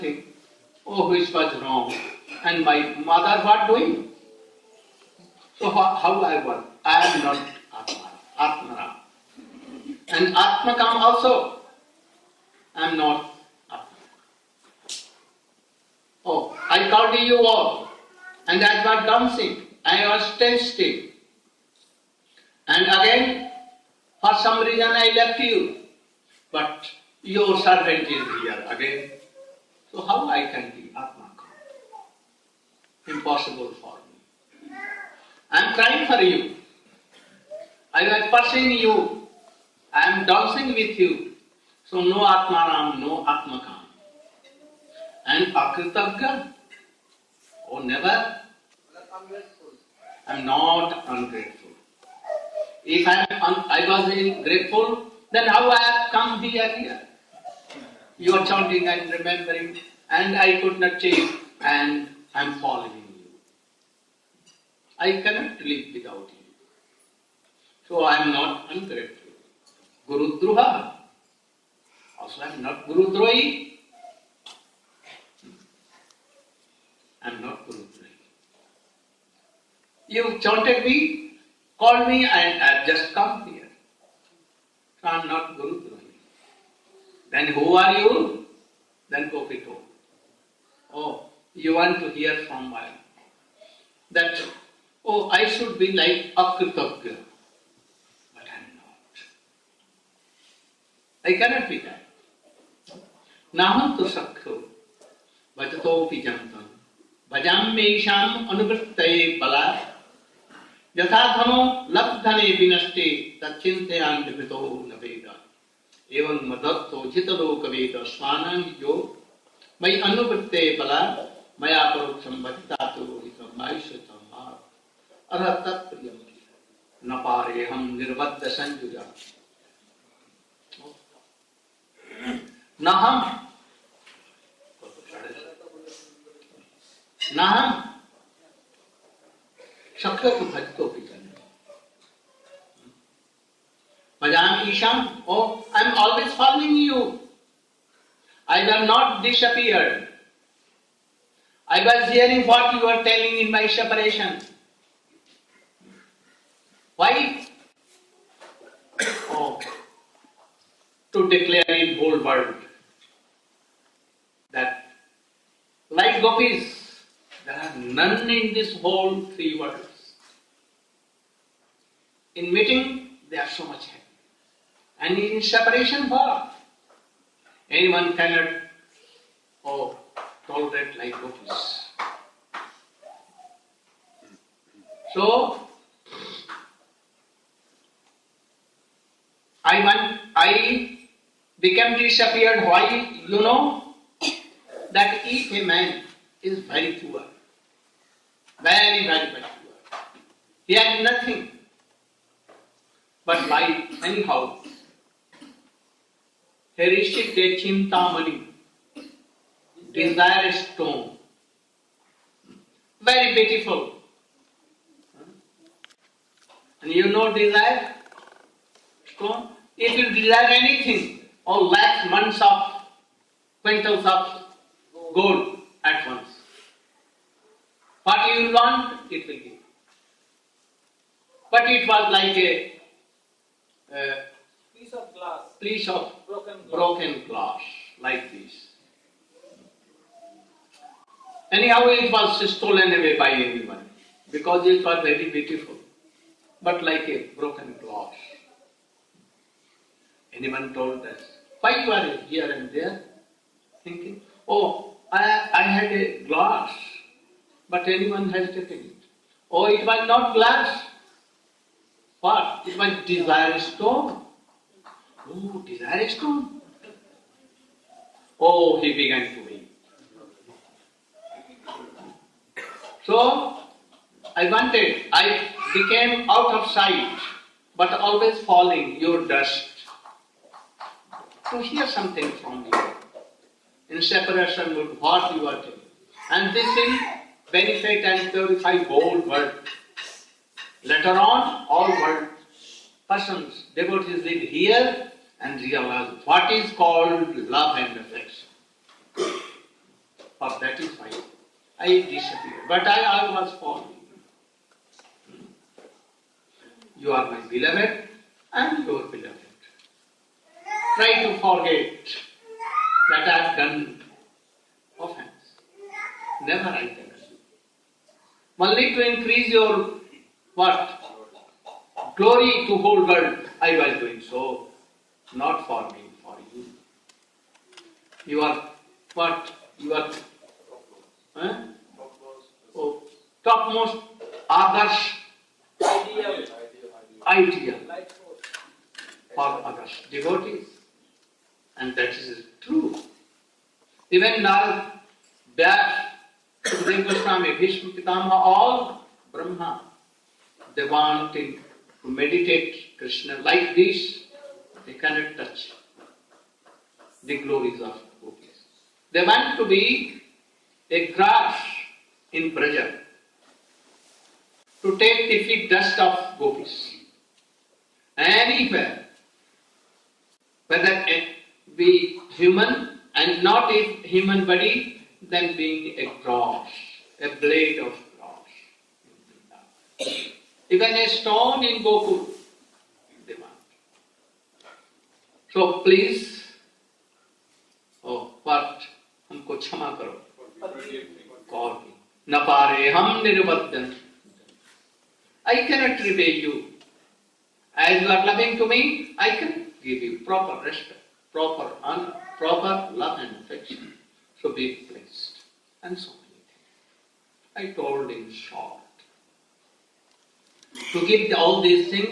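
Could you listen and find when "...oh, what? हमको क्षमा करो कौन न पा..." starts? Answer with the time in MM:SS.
06:28.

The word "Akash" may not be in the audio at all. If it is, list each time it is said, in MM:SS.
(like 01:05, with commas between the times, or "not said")
05:34, 05:39.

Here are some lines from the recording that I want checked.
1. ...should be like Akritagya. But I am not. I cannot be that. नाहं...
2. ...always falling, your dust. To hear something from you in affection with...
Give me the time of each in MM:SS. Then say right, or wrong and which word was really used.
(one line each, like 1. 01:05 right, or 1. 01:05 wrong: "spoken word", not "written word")
1. 01:35 right
2. 04:37 wrong: "separation", not "affection".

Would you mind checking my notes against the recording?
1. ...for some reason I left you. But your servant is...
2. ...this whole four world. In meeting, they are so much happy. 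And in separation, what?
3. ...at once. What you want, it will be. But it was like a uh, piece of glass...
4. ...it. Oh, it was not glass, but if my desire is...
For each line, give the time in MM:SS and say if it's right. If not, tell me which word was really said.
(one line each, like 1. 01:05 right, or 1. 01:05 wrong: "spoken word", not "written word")
1. 00:24 right
2. 02:48 wrong: "three", not "four"
3. 03:45 right
4. 04:18 right.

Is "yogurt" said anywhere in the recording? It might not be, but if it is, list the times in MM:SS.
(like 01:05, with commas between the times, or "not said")
not said.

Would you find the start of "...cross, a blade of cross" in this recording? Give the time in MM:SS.
06:16.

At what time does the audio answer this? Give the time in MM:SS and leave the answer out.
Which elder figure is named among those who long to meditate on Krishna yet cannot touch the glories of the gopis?
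05:47.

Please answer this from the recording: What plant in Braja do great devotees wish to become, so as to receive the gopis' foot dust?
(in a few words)
Grass.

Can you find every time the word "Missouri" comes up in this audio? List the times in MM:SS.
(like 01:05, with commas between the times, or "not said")
not said.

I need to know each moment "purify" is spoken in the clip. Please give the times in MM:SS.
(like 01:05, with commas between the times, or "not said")
04:48.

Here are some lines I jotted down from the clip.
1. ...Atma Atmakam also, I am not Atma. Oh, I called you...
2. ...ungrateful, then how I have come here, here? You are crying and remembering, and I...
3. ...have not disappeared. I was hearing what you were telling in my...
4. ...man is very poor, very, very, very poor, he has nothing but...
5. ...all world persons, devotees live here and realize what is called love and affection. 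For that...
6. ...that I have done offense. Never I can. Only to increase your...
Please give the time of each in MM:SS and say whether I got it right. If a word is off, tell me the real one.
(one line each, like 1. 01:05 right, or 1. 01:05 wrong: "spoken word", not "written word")
1. 00:10 right
2. 00:54 wrong: "chanting", not "crying"
3. 02:28 right
4. 03:15 right
5. 04:51 right
6. 05:13 right.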